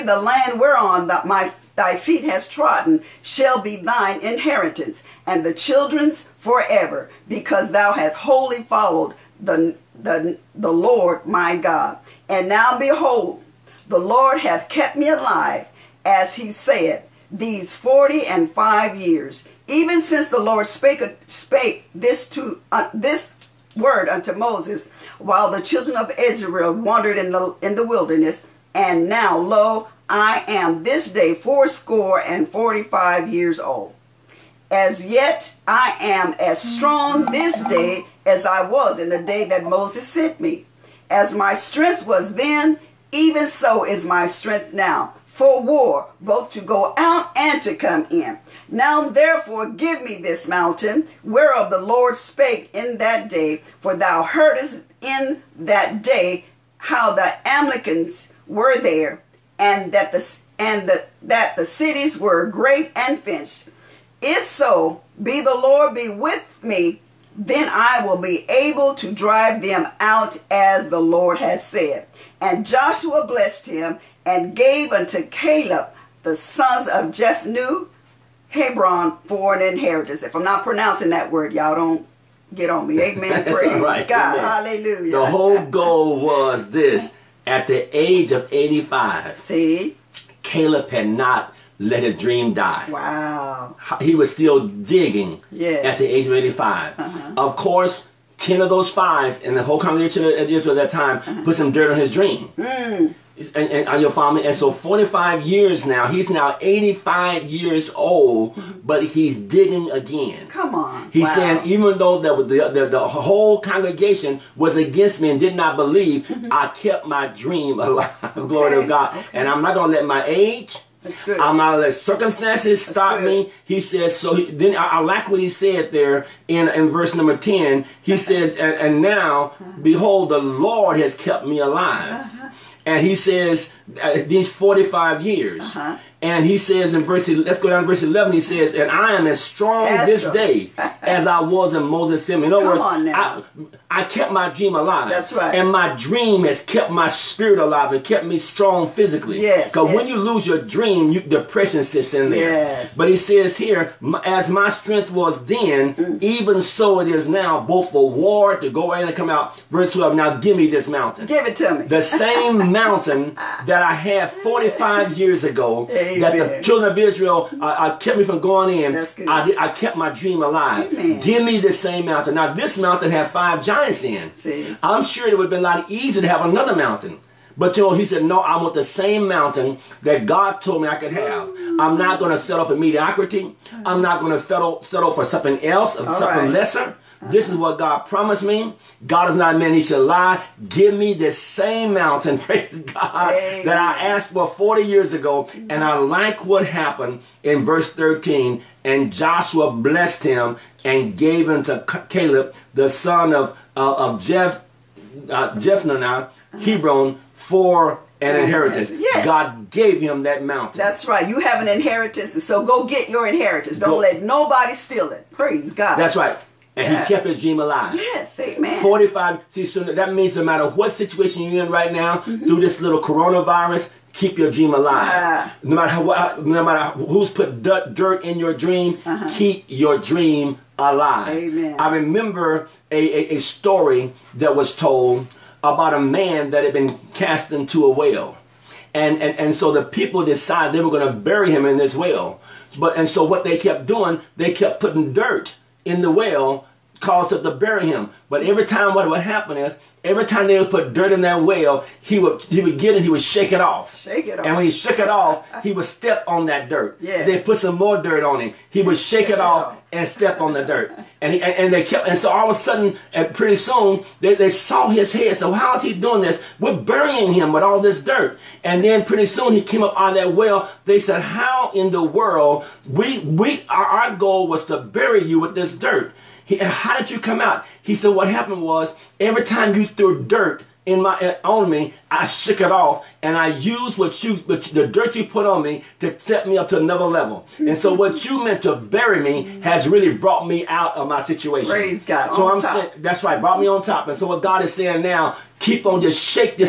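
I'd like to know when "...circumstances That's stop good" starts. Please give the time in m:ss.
2:01.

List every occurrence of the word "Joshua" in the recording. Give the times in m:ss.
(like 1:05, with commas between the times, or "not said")
1:12, 3:19.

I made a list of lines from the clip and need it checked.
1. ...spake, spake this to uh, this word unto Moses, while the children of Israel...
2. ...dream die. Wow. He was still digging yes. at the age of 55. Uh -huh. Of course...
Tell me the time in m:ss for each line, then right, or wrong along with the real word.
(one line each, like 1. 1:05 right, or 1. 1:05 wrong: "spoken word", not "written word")
1. 0:20 right
2. 1:32 wrong: "85", not "55".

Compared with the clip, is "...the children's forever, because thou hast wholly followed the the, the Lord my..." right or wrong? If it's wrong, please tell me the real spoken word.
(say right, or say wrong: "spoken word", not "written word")
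right.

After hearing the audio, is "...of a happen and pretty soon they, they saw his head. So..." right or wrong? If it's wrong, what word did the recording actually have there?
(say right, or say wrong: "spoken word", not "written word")
wrong: "sudden", not "happen".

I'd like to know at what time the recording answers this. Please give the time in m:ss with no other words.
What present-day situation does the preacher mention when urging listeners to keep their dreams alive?
3:43.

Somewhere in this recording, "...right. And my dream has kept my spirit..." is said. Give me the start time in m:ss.
2:25.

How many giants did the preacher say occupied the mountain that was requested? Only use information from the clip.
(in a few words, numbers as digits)
5.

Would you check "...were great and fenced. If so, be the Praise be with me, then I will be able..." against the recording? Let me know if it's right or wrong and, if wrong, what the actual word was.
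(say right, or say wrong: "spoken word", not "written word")
wrong: "Lord", not "Praise".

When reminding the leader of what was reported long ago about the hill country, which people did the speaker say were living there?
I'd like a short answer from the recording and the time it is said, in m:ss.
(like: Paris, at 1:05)
Amalekites, at 0:57.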